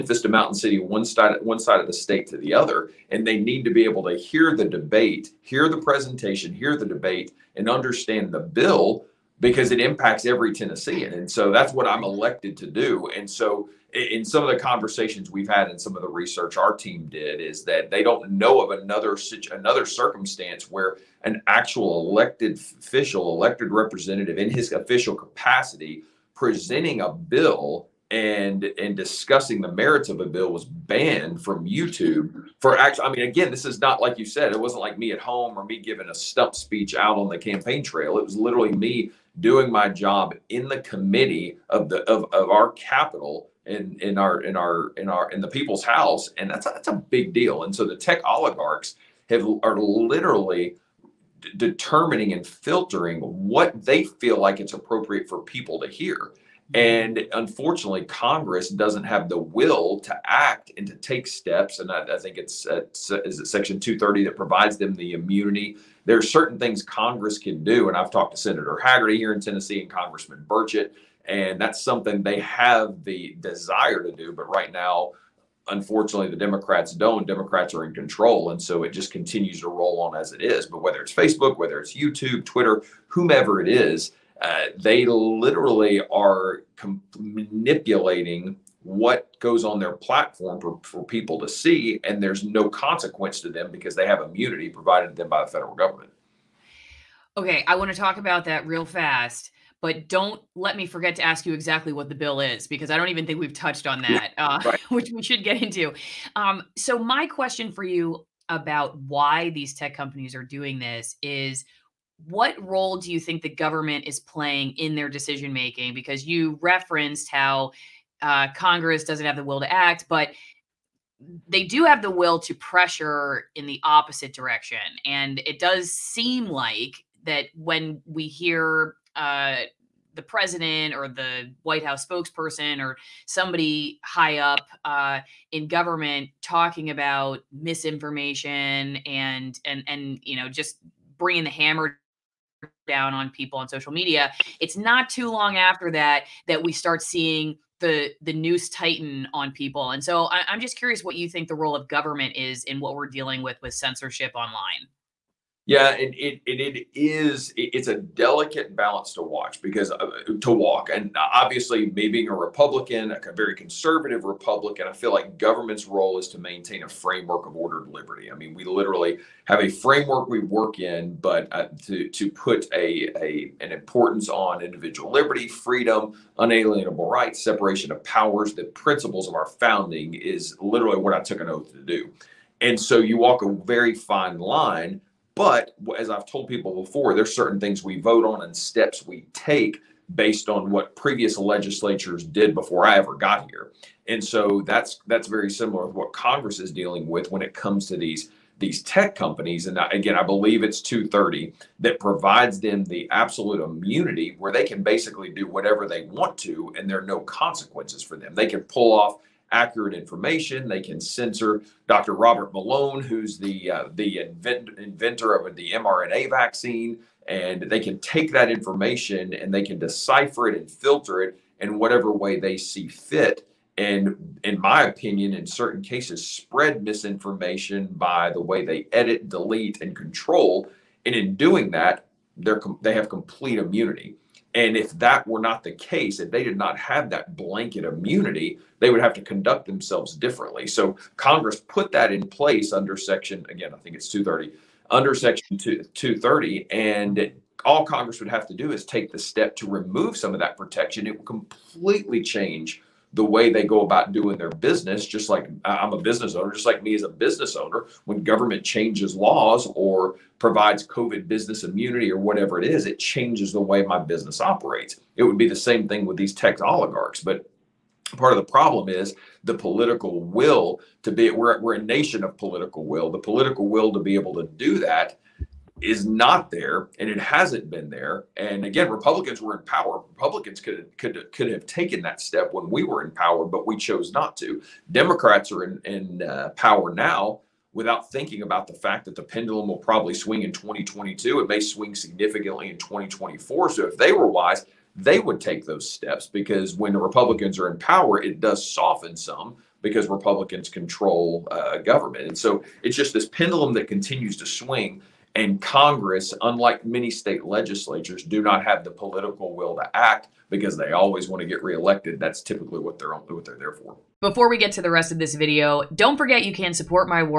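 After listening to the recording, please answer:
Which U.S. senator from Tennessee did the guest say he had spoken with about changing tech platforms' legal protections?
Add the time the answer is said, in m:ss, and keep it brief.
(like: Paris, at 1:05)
Senator Hagerty, at 1:08.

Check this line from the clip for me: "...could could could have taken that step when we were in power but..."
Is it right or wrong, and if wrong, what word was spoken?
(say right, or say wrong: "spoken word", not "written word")
right.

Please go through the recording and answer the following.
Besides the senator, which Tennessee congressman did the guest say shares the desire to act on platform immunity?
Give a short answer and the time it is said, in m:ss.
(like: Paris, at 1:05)
Congressman Burchett, at 1:09.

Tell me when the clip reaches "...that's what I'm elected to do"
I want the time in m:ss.
0:11.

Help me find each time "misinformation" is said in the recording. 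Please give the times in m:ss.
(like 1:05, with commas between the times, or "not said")
2:17, 3:46.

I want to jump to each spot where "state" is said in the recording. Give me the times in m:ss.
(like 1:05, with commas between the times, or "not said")
0:01, 5:07.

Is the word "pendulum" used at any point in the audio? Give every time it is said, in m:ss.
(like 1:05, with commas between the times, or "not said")
4:49, 5:03.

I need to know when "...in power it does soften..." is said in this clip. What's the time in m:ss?
4:57.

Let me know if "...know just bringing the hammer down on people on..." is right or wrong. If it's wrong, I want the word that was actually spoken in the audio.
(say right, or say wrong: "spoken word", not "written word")
right.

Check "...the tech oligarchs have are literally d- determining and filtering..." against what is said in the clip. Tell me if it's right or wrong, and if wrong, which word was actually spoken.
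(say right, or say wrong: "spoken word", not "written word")
right.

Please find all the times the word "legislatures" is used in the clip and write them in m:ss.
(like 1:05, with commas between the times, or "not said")
3:11, 5:07.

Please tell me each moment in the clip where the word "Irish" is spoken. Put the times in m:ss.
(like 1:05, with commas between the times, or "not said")
not said.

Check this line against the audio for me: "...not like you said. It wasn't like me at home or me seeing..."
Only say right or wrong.
wrong.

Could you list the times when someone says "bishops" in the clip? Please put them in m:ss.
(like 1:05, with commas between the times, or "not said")
not said.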